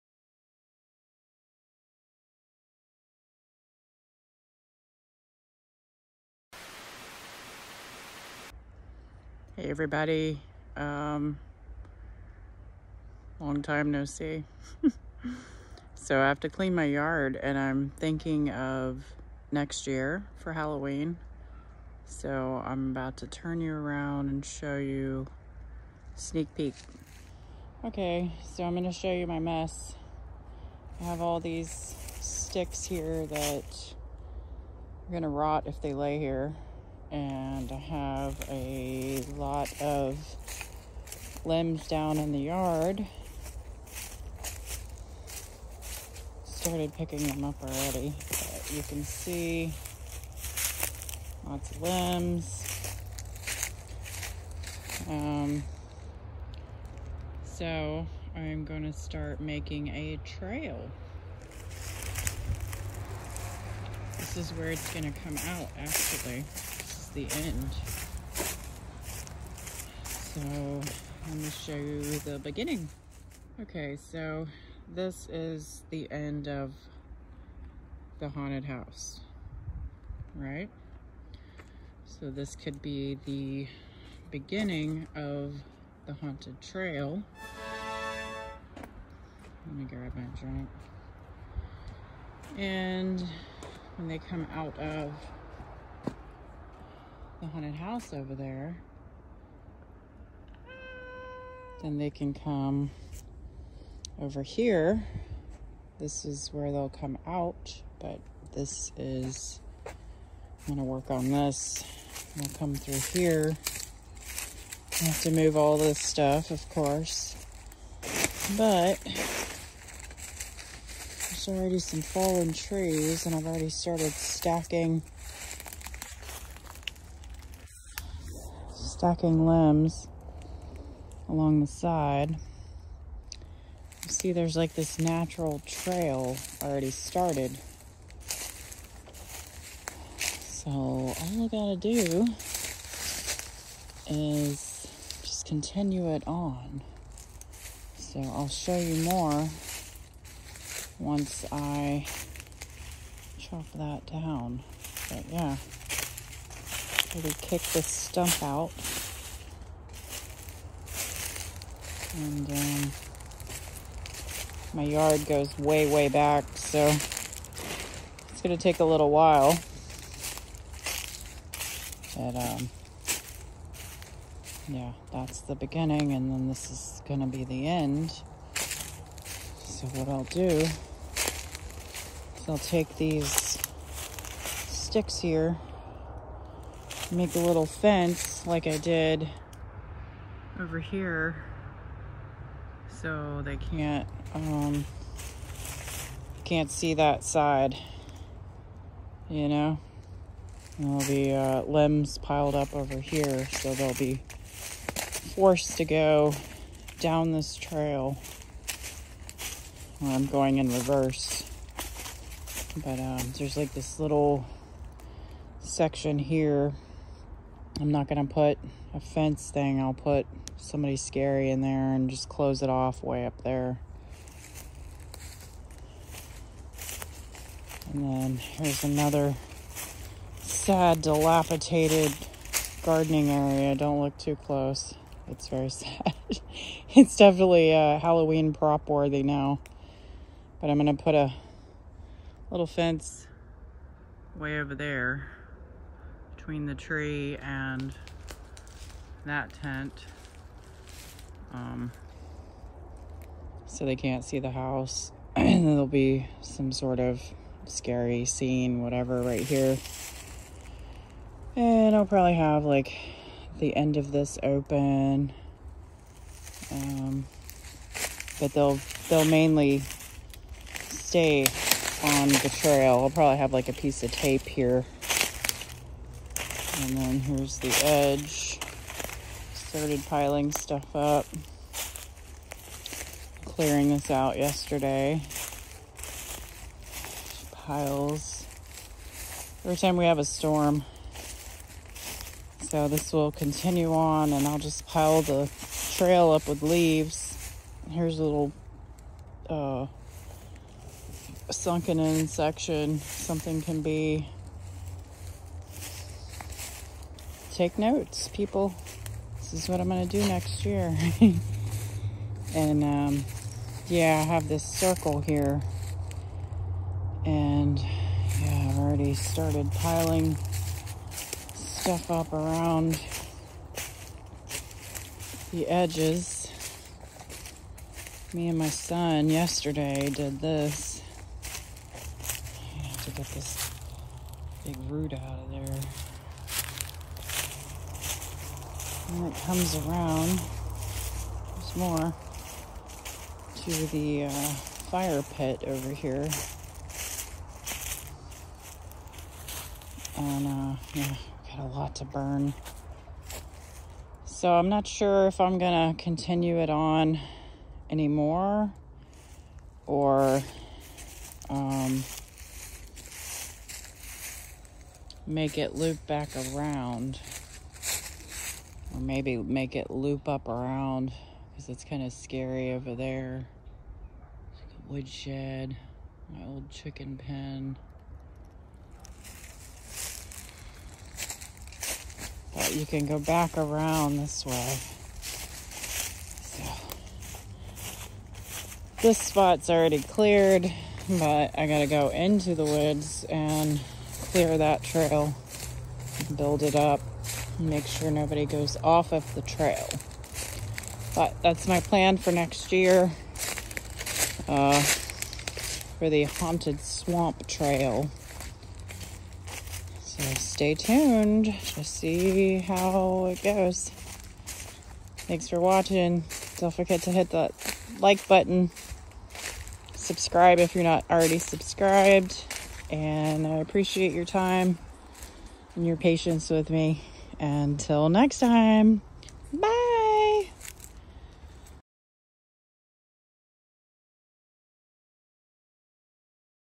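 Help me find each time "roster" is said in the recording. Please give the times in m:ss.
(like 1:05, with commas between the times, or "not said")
not said.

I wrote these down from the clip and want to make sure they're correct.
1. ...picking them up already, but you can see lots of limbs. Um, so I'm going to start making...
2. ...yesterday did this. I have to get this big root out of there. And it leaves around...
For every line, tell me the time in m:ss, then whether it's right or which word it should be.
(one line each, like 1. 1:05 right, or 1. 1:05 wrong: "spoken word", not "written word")
1. 0:46 right
2. 5:29 wrong: "comes", not "leaves".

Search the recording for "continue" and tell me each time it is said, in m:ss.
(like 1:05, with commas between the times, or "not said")
2:25, 4:53, 5:56.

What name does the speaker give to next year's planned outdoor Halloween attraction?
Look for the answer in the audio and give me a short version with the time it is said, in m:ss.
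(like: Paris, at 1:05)
Haunted Swamp Trail, at 6:46.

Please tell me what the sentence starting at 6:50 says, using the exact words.
So stay tuned to see how it goes.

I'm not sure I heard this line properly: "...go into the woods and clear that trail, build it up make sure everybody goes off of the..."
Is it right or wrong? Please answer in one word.
wrong.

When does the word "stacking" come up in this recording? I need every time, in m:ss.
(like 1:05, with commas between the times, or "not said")
2:04, 2:09.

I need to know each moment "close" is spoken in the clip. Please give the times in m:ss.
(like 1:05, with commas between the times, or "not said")
3:42, 3:54.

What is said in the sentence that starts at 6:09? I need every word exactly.
Or maybe make it loop up around because it's kind of scary over there.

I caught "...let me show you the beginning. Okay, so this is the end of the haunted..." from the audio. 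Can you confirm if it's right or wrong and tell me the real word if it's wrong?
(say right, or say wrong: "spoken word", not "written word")
right.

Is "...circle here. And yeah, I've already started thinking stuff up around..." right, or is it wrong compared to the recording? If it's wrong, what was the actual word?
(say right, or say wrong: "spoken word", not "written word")
wrong: "piling", not "thinking".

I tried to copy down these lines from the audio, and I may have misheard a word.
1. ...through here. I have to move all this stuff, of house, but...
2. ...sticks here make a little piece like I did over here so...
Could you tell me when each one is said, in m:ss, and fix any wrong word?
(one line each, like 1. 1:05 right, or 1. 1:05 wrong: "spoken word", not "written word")
1. 1:52 wrong: "course", not "house"
2. 3:04 wrong: "fence", not "piece".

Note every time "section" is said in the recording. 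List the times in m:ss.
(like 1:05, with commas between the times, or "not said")
3:35, 5:02.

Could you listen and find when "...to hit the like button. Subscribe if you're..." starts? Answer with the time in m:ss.
6:57.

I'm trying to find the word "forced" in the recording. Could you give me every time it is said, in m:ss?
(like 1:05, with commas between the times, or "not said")
3:25.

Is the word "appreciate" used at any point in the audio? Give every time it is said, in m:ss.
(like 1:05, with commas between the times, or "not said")
7:03.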